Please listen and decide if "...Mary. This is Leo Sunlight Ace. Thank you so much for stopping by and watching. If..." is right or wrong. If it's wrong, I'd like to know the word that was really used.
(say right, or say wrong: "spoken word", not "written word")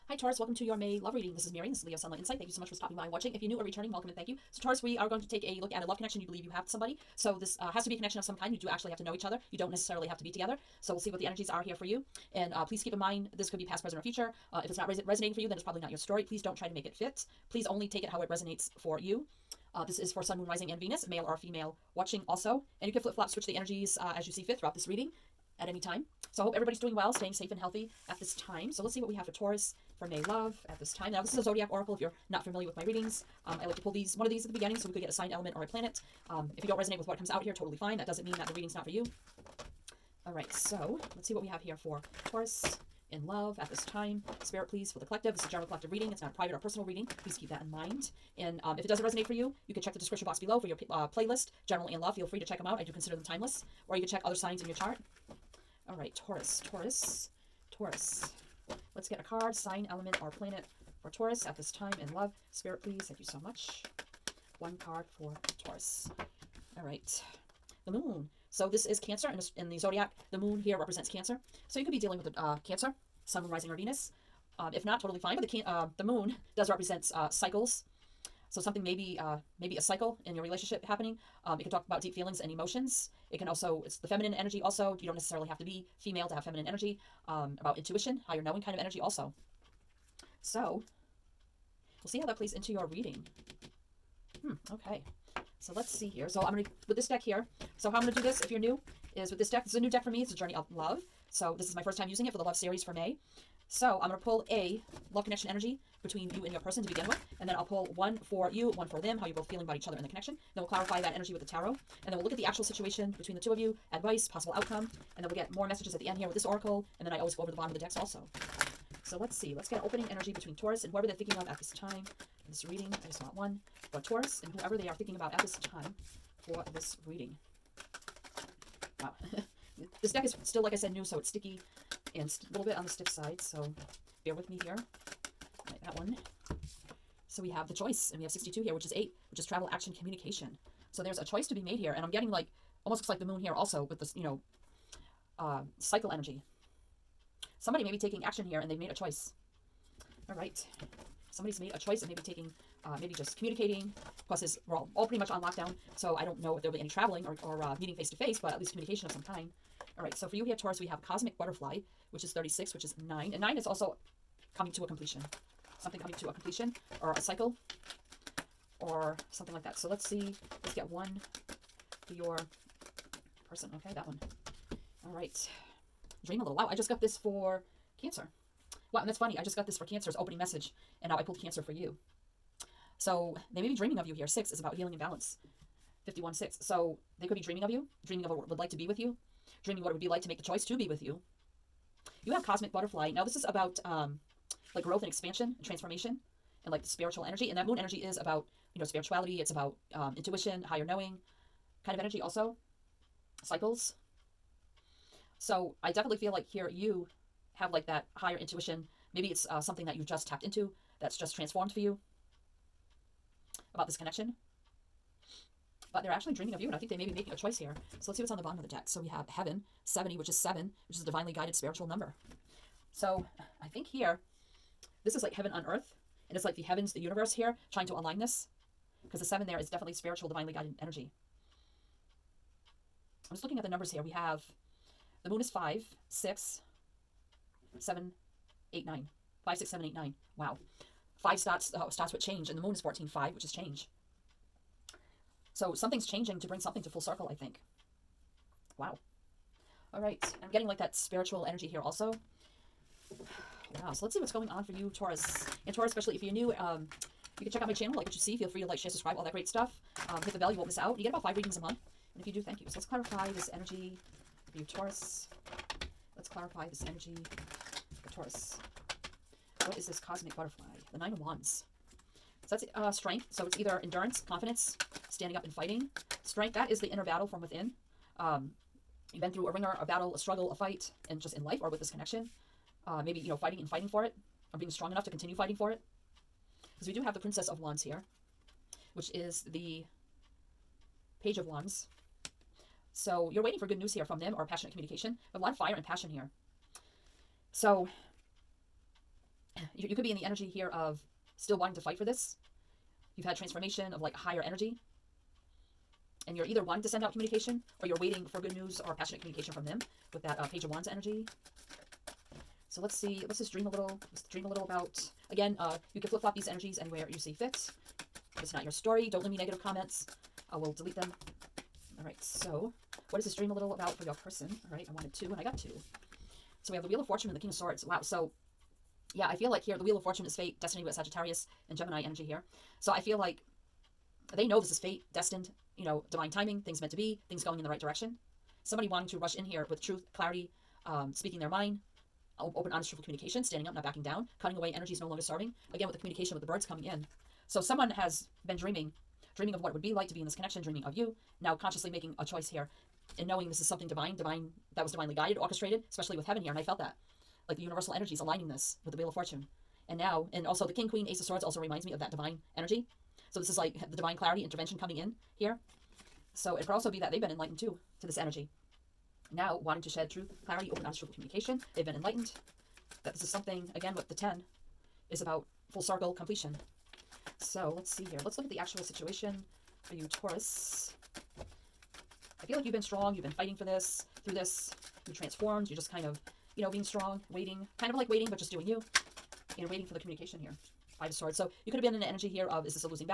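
wrong: "Insight", not "Ace".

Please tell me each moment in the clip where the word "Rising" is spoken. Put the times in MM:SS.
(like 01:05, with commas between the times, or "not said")
00:20, 01:13.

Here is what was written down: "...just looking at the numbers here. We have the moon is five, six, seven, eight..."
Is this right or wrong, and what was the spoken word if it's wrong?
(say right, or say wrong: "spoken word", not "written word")
right.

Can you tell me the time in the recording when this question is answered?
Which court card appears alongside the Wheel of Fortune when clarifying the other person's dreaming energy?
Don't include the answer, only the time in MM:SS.
05:27.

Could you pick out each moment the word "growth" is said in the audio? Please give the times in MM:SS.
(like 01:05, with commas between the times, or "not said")
03:14.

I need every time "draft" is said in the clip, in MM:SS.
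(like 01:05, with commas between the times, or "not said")
not said.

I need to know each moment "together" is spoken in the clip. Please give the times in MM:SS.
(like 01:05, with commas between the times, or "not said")
00:10.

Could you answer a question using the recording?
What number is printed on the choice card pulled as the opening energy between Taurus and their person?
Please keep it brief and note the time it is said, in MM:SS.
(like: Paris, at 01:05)
62, at 02:18.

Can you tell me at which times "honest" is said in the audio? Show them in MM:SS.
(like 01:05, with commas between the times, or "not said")
05:42, 06:10.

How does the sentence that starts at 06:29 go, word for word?
And waiting for the communication here.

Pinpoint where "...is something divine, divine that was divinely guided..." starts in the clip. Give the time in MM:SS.
05:53.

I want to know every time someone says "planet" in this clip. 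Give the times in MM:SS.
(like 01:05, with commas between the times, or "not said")
00:35, 01:00.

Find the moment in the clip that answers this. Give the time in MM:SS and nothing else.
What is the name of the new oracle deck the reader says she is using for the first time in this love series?
01:40.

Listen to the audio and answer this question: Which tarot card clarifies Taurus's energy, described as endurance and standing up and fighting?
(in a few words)
Nine of Wands.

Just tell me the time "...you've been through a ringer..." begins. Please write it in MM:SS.
04:39.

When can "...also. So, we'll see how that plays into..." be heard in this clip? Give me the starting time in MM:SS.
01:28.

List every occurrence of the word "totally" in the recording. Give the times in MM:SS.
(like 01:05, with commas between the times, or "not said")
00:37, 01:14.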